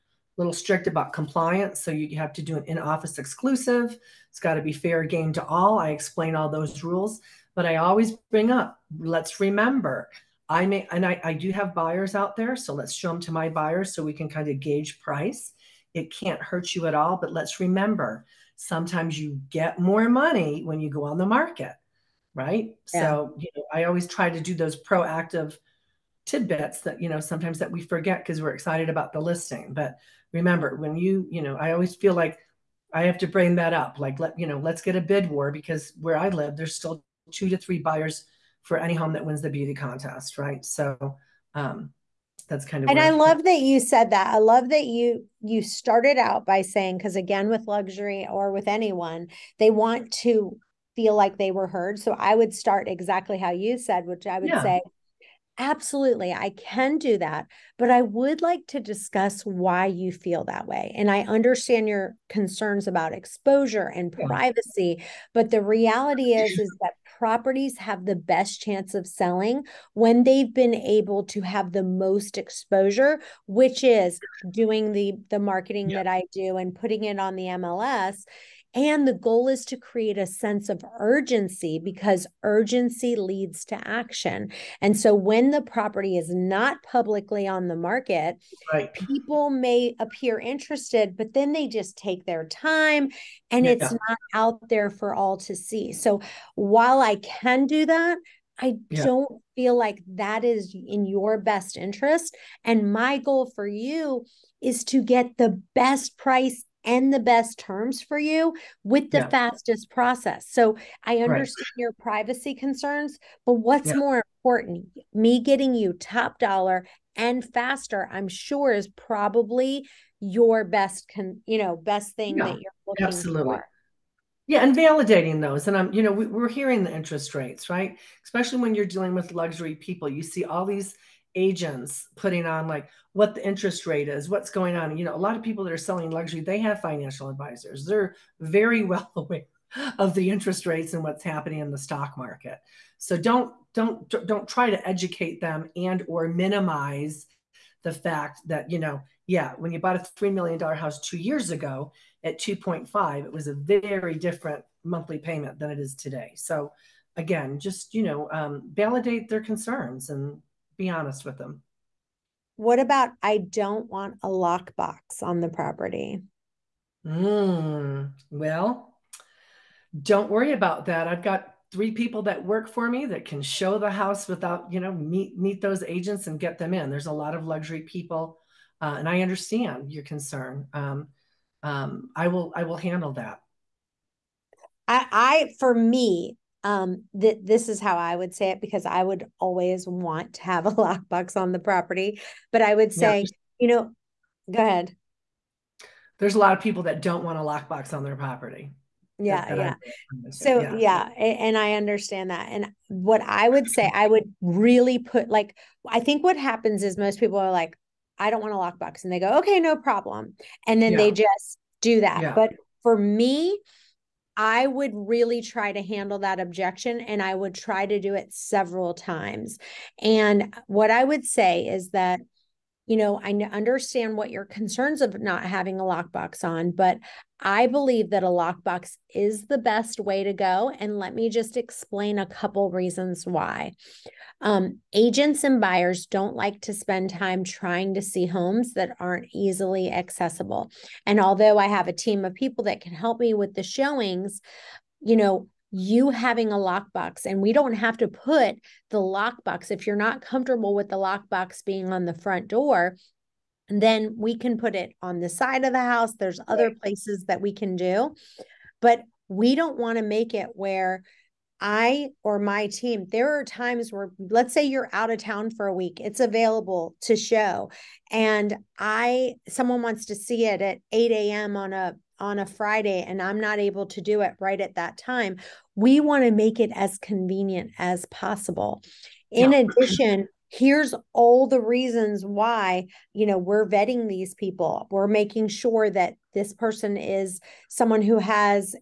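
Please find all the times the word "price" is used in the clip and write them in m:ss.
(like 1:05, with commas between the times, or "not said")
0:15, 1:46.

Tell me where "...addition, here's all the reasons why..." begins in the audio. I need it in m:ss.
4:39.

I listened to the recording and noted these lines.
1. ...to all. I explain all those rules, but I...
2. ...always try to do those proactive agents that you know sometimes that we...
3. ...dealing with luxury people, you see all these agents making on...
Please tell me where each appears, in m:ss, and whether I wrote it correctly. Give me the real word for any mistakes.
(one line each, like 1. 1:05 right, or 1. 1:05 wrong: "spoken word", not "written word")
1. 0:05 right
2. 0:23 wrong: "tidbits", not "agents"
3. 2:08 wrong: "putting", not "making".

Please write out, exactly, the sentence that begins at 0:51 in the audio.
So I would start exactly how you said, which I would yeah.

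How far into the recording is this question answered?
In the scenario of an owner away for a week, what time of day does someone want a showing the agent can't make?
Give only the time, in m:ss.
4:30.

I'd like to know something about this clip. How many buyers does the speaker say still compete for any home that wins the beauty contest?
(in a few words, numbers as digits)
2 to 3.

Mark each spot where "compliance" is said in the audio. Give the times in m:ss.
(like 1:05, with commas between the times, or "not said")
0:01.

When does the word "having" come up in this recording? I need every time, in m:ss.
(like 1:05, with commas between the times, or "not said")
3:45, 4:06.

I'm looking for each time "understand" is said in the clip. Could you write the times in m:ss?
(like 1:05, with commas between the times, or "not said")
1:01, 1:51, 2:59, 3:21, 3:43.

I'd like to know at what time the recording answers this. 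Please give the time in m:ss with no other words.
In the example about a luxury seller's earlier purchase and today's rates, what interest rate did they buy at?
2:32.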